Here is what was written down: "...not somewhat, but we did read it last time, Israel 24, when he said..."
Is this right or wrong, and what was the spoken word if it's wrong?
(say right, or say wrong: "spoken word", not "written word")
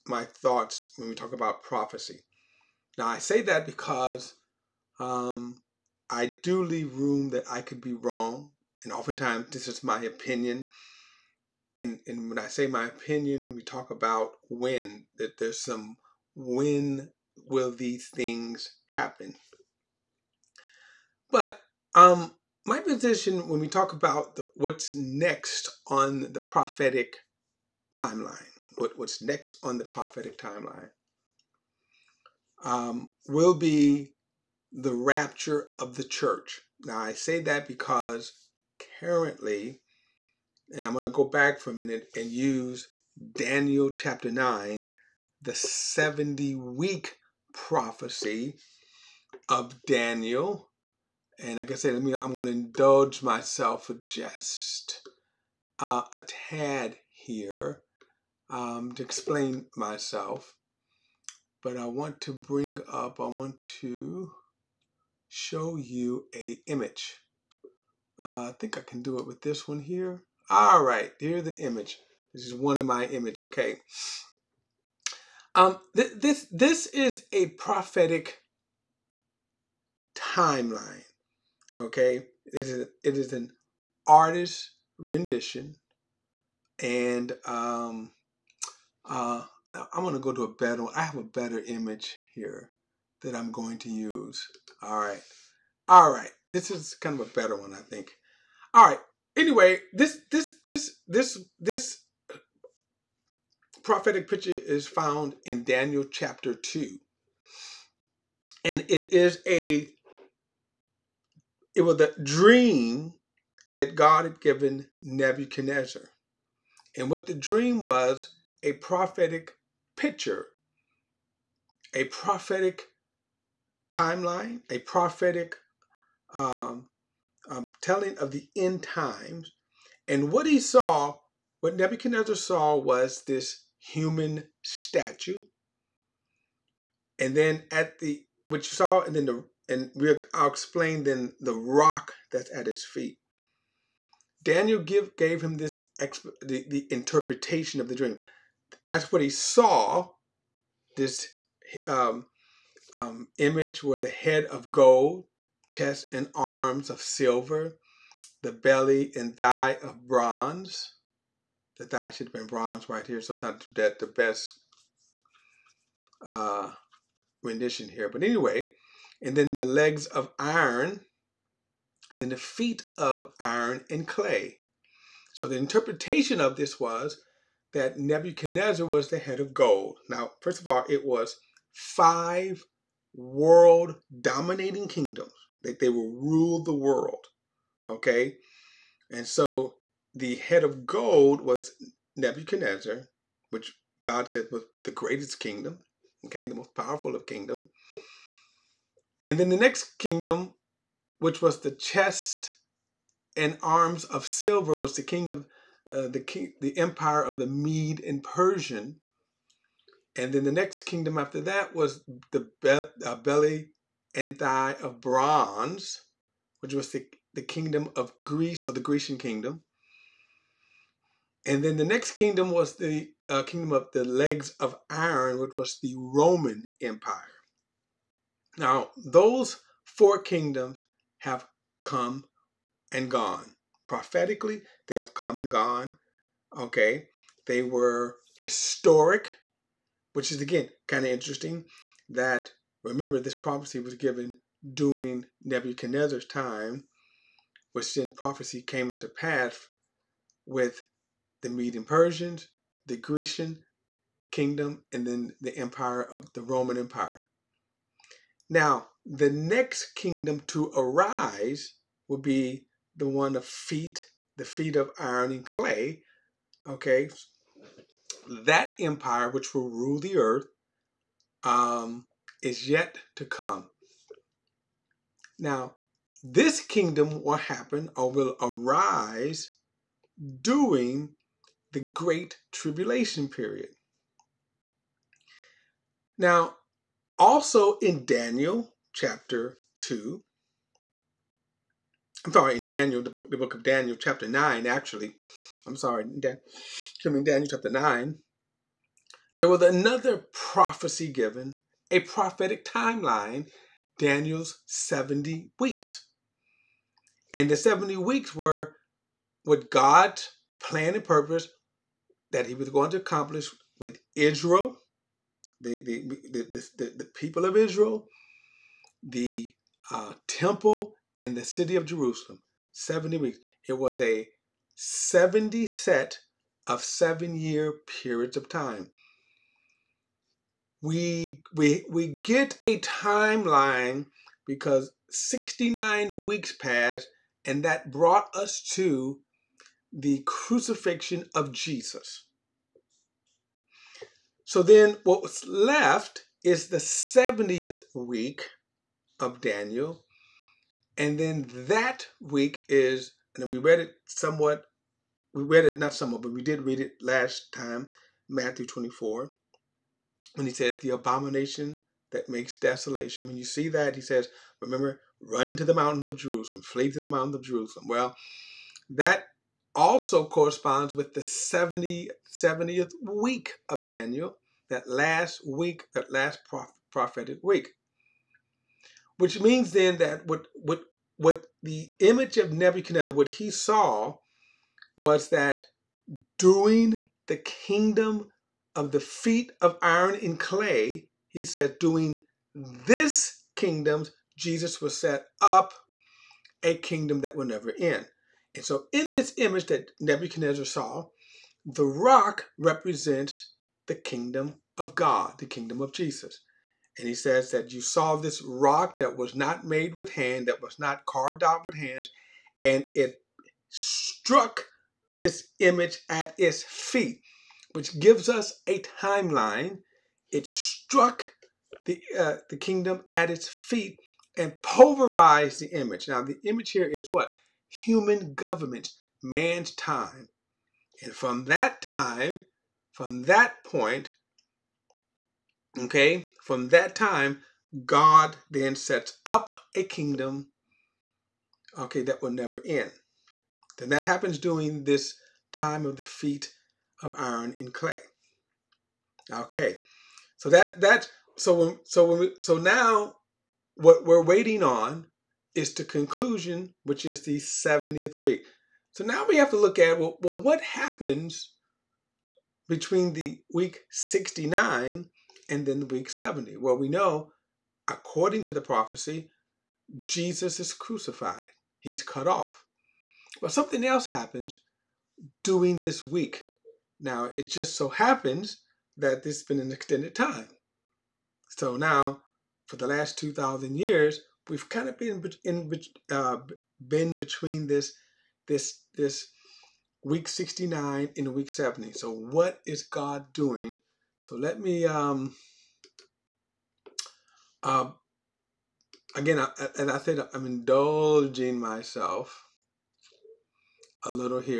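wrong: "Matthew", not "Israel".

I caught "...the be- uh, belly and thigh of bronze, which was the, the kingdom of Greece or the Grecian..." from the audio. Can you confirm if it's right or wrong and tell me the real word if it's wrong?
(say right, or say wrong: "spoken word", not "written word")
right.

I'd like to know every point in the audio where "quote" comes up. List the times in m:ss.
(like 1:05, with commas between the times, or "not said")
not said.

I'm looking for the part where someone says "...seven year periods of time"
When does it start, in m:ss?
5:26.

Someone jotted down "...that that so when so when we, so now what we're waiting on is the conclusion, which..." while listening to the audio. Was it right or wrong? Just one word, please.
right.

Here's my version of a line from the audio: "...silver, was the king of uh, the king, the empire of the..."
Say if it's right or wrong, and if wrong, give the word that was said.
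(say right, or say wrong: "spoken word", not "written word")
right.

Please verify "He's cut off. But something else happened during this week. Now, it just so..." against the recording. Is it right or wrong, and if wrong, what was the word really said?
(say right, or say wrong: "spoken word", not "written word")
right.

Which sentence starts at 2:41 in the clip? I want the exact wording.
The thigh should have been bronze right here.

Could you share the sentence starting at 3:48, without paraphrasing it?
Now, those four kingdoms have come and gone.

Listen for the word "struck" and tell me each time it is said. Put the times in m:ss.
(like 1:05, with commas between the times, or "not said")
6:53, 7:00.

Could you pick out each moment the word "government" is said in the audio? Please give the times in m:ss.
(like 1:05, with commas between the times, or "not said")
7:08.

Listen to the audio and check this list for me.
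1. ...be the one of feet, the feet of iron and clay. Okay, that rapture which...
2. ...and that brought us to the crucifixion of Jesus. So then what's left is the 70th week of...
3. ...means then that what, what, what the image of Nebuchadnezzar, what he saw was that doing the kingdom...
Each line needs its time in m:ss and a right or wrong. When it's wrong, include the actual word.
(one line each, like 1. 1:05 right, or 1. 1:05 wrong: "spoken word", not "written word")
1. 4:22 wrong: "empire", not "rapture"
2. 5:37 right
3. 6:19 right.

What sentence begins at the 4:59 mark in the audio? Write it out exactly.
There was another prophecy given, a prophetic timeline, Daniel's 70 weeks.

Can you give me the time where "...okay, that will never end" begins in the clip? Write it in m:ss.
7:21.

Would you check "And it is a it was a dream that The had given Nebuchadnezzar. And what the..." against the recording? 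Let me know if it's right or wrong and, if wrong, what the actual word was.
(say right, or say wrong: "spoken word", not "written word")
wrong: "God", not "The".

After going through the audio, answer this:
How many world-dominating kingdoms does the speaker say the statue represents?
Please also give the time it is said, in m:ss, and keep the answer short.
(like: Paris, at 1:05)
5, at 3:01.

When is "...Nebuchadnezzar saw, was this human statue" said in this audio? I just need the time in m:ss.
2:11.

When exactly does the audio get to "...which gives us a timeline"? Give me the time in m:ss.
6:57.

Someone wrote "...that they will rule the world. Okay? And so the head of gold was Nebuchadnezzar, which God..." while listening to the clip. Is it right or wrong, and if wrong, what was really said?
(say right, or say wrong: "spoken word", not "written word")
right.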